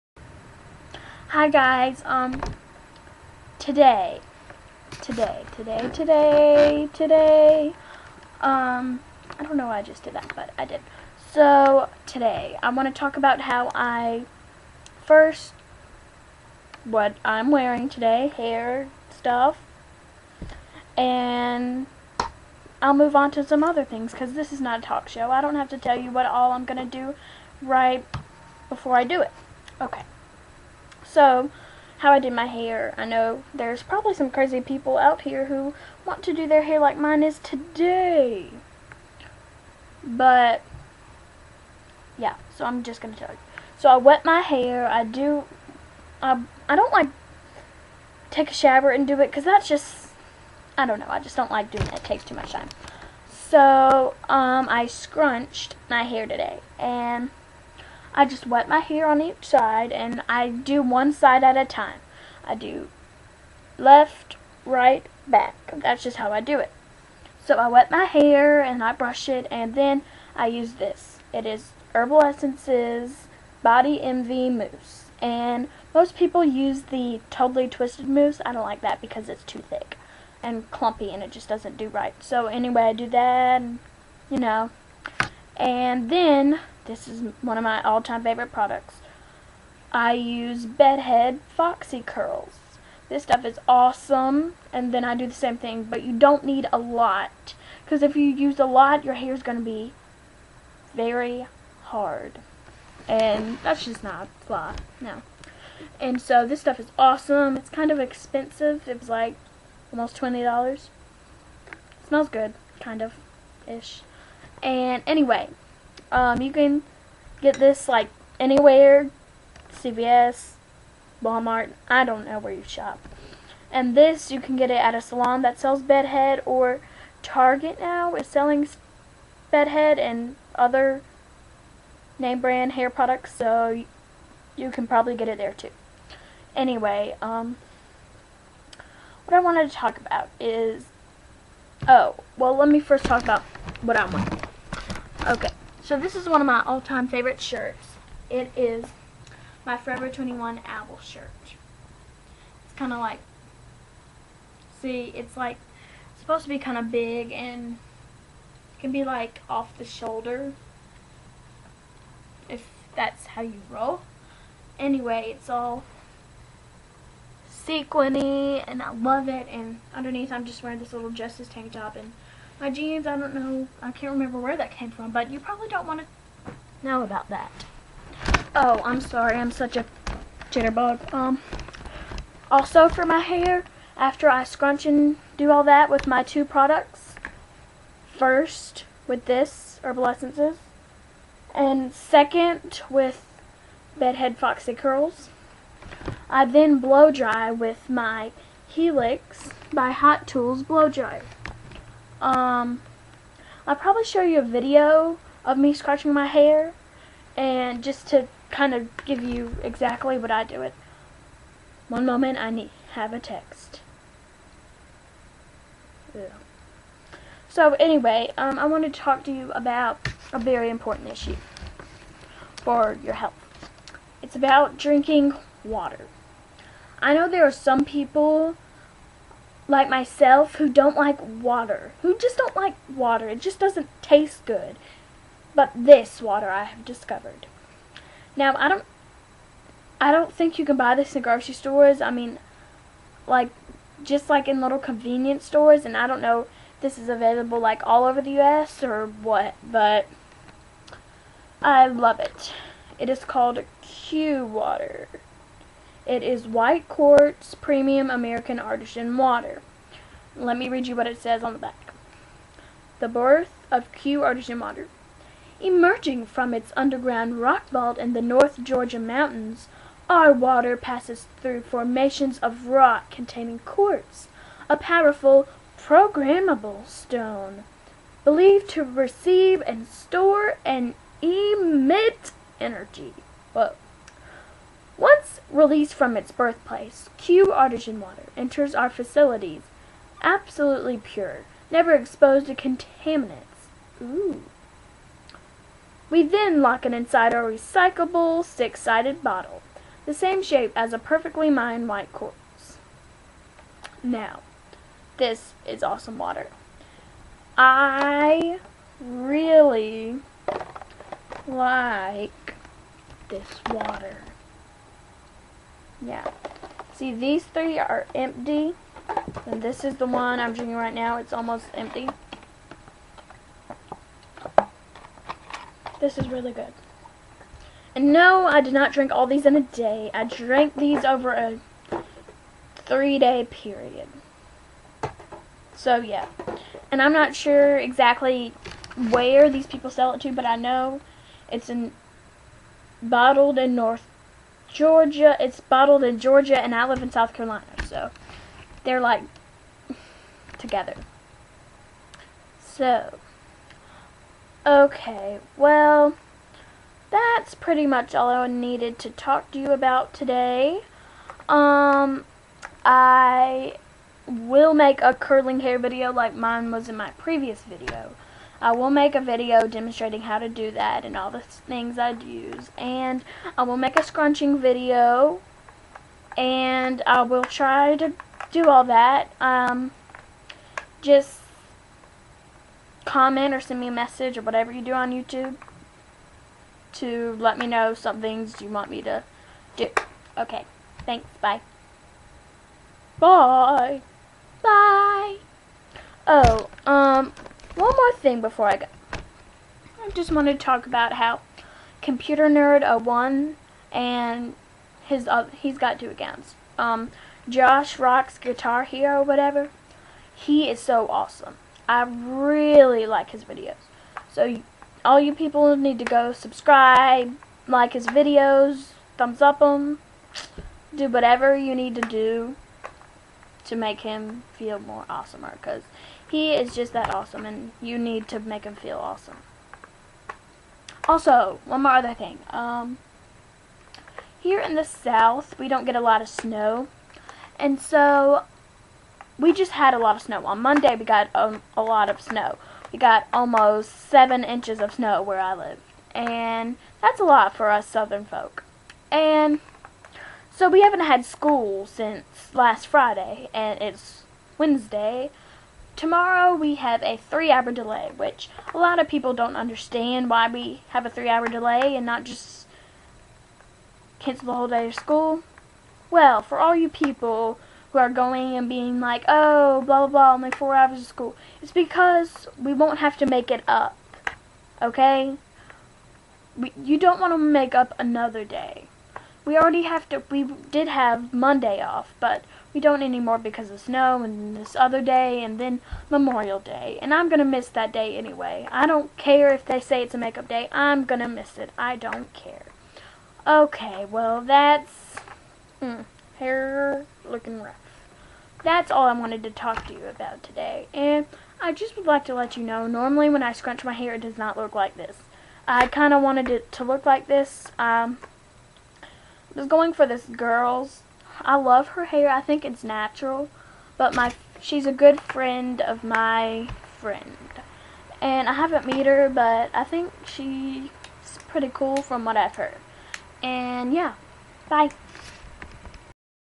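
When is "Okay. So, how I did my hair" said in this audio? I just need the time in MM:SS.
00:29.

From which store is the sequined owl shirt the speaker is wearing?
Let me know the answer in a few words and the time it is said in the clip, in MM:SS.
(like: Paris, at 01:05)
Forever 21, at 02:29.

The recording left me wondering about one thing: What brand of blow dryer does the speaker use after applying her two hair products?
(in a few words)
Helix by Hot Tools.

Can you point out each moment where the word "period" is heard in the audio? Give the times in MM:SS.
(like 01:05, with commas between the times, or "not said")
05:33.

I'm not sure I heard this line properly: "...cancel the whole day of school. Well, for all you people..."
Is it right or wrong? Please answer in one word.
right.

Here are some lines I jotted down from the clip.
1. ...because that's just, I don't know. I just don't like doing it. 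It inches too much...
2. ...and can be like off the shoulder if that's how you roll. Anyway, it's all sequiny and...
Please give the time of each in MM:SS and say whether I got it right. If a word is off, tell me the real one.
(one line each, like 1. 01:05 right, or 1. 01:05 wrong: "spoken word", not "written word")
1. 00:49 wrong: "takes", not "inches"
2. 02:37 right.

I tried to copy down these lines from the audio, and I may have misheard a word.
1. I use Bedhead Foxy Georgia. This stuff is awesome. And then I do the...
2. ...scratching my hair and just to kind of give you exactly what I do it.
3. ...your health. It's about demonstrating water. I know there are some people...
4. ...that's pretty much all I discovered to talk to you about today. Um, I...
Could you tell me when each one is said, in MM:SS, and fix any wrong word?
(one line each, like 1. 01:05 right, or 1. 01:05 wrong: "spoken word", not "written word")
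1. 01:29 wrong: "Curls", not "Georgia"
2. 03:25 right
3. 03:43 wrong: "drinking", not "demonstrating"
4. 05:57 wrong: "needed", not "discovered".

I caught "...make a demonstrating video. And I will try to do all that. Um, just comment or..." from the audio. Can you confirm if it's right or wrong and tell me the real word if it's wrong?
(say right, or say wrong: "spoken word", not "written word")
wrong: "scrunching", not "demonstrating".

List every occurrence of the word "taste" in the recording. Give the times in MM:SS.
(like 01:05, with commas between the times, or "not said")
03:54.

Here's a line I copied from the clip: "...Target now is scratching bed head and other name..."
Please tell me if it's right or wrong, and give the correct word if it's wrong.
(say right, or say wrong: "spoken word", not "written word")
wrong: "selling", not "scratching".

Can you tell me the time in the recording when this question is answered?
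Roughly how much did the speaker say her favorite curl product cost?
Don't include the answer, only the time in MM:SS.
01:49.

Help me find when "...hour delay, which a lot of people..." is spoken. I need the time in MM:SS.
07:37.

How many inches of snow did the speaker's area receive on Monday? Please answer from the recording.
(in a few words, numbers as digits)
7.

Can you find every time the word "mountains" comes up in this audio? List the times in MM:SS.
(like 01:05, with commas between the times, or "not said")
04:28.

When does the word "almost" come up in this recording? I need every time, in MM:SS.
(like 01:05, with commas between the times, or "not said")
01:49, 05:21, 07:23.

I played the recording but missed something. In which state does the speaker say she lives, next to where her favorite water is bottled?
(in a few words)
South Carolina.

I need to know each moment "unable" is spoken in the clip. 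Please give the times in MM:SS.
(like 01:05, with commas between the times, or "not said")
not said.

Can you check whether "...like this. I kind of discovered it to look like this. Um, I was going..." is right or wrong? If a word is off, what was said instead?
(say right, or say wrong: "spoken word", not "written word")
wrong: "wanted", not "discovered".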